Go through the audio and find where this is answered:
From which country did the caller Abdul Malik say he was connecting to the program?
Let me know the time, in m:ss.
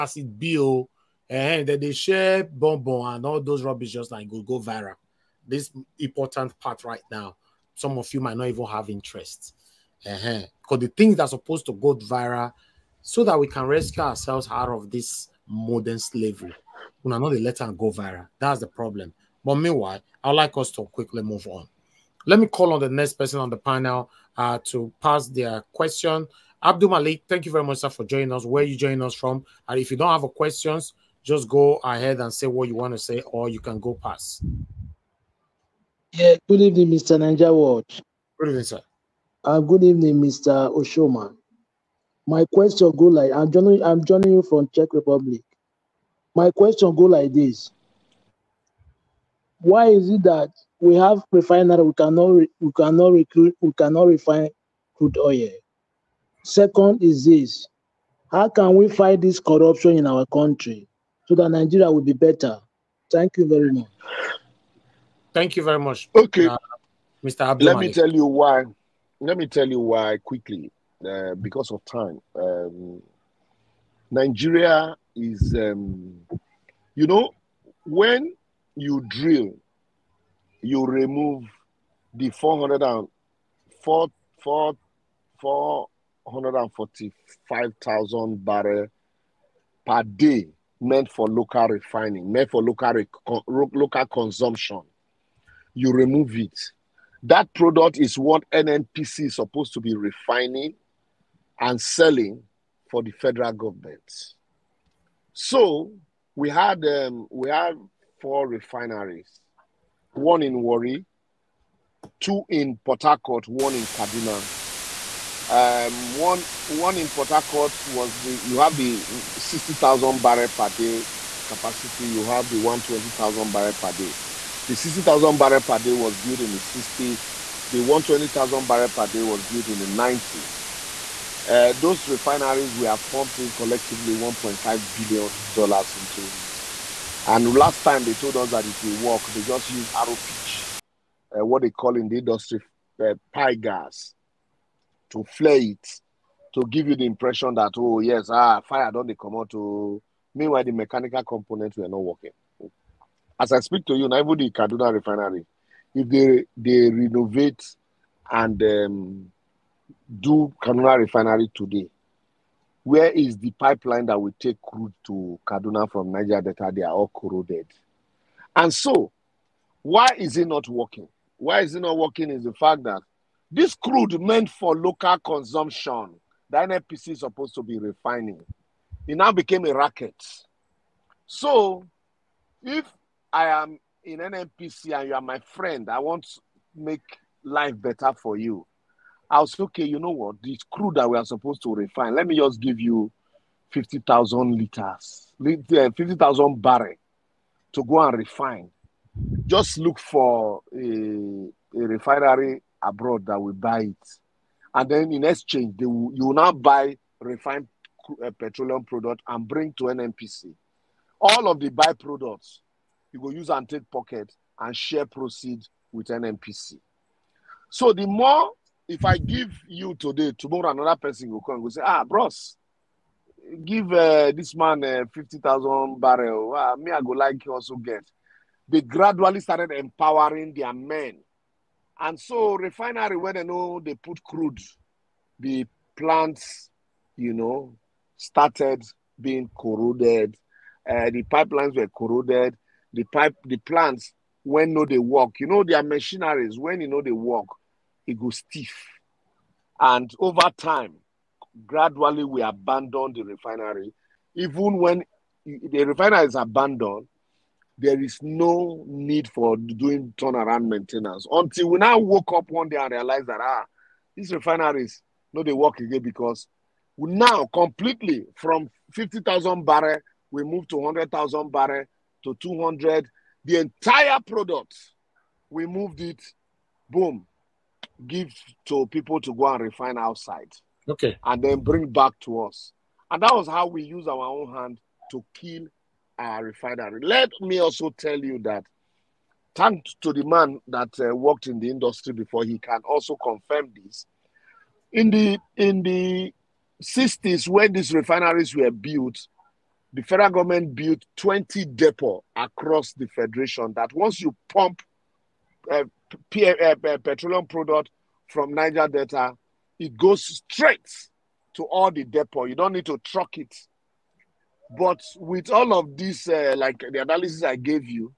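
0:44.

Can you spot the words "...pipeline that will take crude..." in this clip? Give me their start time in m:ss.
2:43.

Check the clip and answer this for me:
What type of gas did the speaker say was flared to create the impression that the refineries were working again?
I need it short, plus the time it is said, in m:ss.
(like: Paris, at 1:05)
pie gas, at 2:23.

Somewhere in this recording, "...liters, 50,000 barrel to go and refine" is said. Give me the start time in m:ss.
3:14.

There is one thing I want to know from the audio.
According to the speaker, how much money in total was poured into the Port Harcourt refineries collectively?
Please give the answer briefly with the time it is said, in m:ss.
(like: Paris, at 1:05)
$1.5 billion, at 2:14.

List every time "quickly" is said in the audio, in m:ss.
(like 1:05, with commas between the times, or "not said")
0:20, 1:10.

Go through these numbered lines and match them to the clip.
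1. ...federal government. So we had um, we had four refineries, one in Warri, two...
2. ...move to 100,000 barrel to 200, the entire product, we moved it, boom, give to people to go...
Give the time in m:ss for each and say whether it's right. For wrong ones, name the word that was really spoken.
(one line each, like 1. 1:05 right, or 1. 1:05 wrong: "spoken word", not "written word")
1. 1:43 right
2. 4:30 right.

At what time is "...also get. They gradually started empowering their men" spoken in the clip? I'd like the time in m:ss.
3:47.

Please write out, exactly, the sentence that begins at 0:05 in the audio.
This important part right now some of you might not even have interest.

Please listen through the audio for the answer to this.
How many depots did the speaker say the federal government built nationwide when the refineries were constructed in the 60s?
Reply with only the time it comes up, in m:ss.
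5:01.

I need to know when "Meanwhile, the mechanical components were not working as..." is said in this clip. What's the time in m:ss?
2:30.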